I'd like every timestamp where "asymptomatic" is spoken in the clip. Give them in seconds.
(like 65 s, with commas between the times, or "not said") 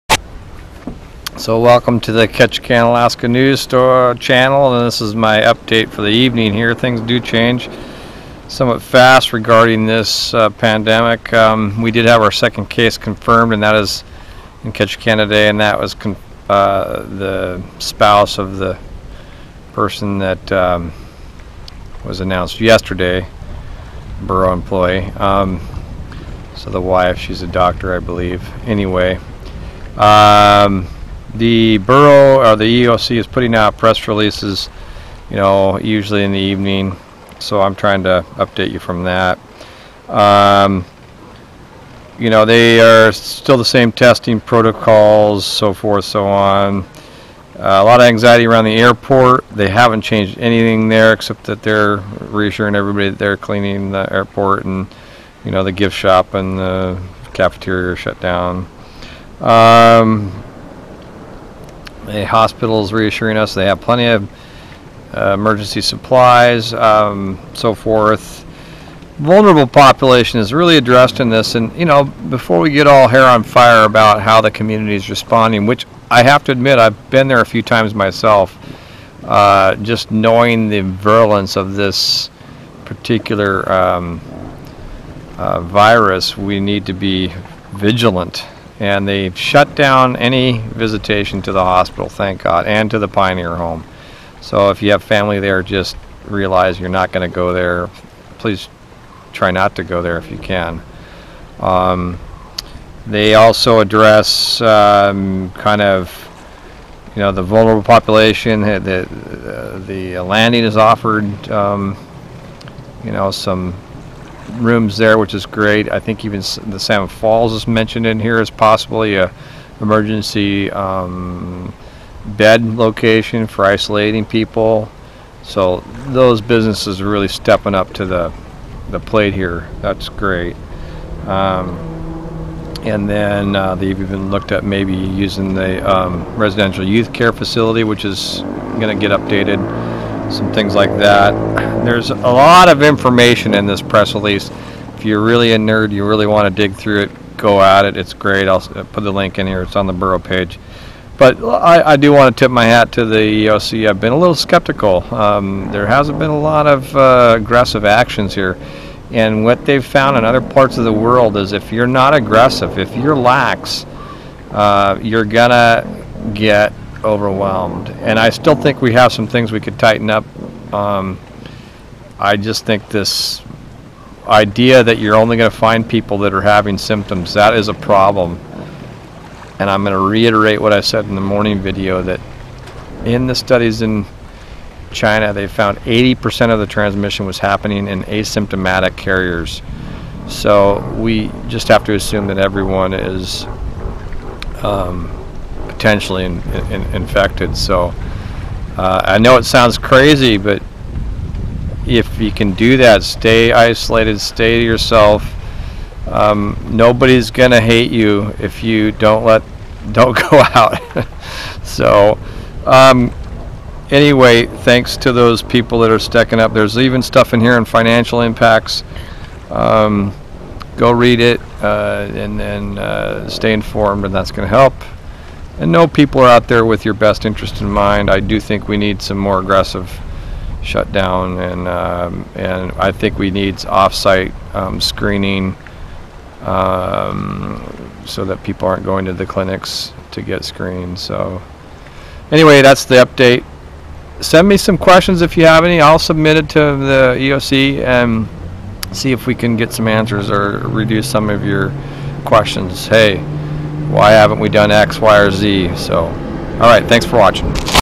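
188 s.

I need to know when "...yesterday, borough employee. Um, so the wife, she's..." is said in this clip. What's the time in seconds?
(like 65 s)
22 s.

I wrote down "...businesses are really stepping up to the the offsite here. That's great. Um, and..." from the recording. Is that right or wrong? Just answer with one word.
wrong.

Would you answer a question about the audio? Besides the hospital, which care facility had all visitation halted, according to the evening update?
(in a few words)
Pioneer Home.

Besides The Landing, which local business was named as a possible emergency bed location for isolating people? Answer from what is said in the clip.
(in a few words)
Salmon Falls.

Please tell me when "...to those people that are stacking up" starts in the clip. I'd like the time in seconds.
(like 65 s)
214 s.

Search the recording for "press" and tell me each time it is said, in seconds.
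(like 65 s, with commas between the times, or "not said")
33 s, 143 s.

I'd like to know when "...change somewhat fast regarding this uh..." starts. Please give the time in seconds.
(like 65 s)
7 s.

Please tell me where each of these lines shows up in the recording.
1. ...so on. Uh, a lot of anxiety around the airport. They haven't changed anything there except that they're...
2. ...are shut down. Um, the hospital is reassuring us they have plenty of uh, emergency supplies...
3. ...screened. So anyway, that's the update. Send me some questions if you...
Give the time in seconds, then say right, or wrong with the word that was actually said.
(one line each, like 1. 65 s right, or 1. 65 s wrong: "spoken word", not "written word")
1. 46 s right
2. 57 s right
3. 240 s right.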